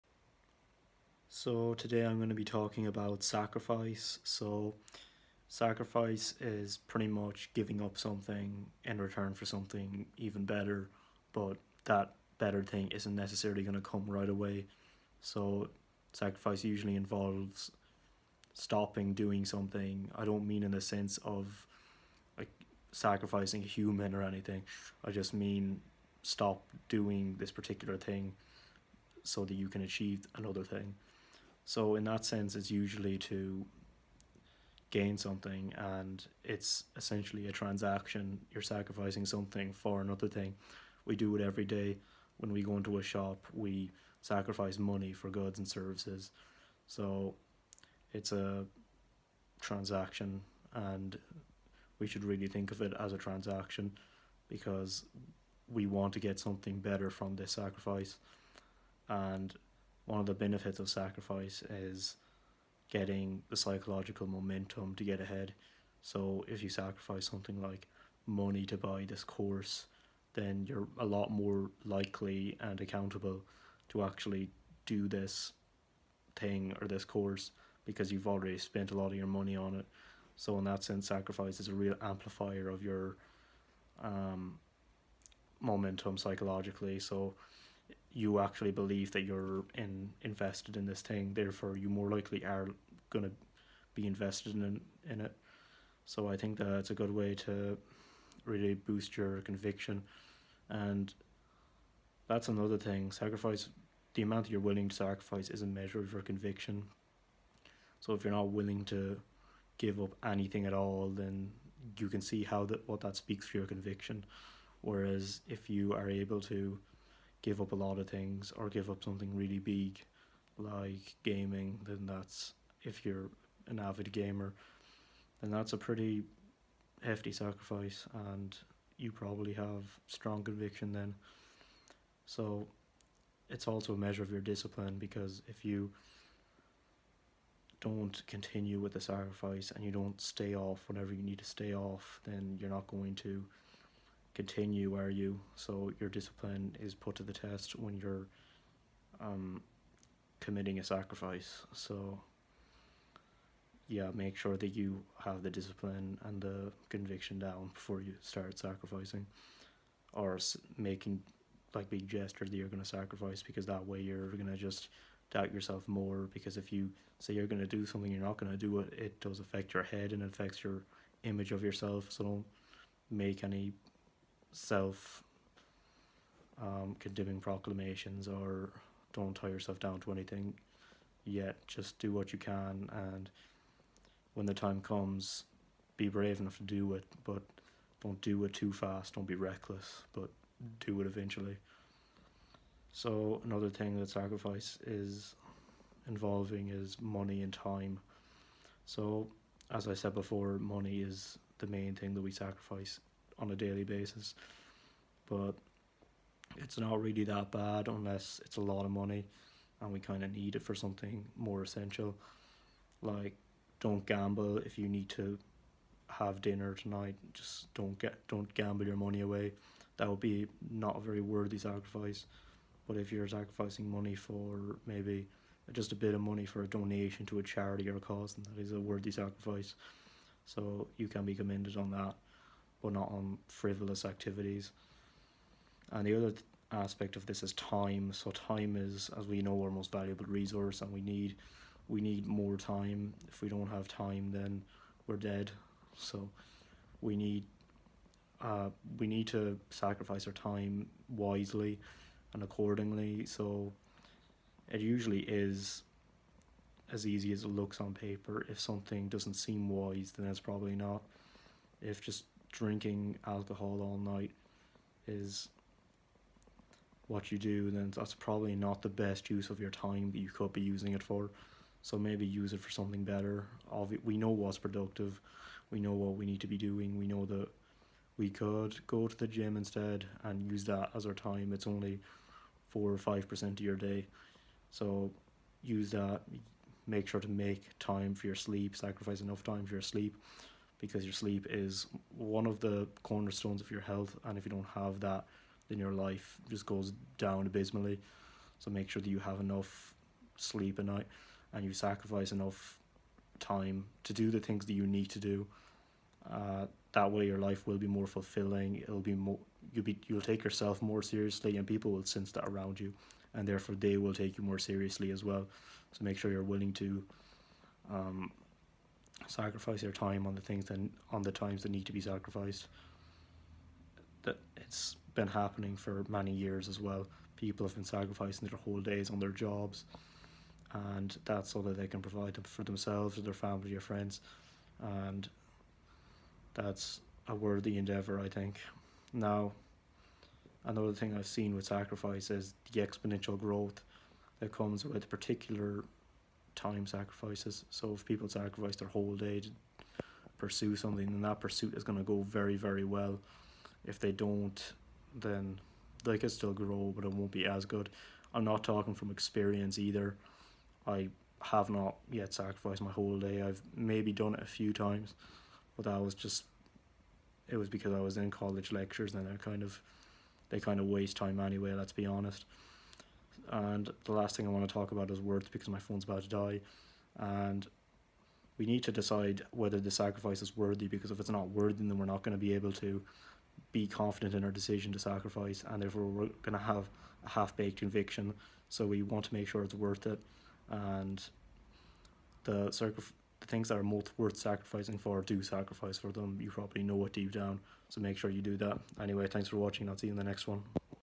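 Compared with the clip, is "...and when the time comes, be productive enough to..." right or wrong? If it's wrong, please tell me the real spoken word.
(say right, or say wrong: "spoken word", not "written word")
wrong: "brave", not "productive".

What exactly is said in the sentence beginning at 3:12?
So, another thing that sacrifice is involving is money and time.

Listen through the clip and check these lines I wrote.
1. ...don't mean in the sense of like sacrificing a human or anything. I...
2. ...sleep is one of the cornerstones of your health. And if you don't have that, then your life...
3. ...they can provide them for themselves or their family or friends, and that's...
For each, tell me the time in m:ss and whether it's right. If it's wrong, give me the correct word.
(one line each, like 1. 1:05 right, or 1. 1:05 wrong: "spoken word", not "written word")
1. 0:20 right
2. 4:51 right
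3. 5:31 right.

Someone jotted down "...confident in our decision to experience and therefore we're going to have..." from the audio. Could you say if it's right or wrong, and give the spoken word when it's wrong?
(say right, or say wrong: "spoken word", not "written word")
wrong: "sacrifice", not "experience".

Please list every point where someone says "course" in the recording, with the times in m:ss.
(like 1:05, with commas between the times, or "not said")
1:09, 1:17.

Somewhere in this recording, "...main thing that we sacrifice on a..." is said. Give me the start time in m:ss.
3:21.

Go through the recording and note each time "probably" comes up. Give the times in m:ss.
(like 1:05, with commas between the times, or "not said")
2:09, 4:20, 4:28, 6:36.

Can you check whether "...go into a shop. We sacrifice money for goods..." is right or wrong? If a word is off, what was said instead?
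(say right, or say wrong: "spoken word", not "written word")
right.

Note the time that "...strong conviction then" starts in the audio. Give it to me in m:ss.
2:10.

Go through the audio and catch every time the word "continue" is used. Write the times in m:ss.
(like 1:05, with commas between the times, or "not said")
2:18, 2:24.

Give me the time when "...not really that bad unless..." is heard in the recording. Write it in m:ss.
3:26.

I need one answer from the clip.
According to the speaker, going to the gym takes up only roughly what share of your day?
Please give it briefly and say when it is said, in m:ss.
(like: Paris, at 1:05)
4 or 5%, at 4:42.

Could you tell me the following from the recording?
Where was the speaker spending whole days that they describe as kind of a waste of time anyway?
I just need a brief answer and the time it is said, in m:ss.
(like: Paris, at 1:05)
college lectures, at 6:08.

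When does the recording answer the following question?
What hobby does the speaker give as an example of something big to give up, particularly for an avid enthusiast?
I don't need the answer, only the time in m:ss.
2:01.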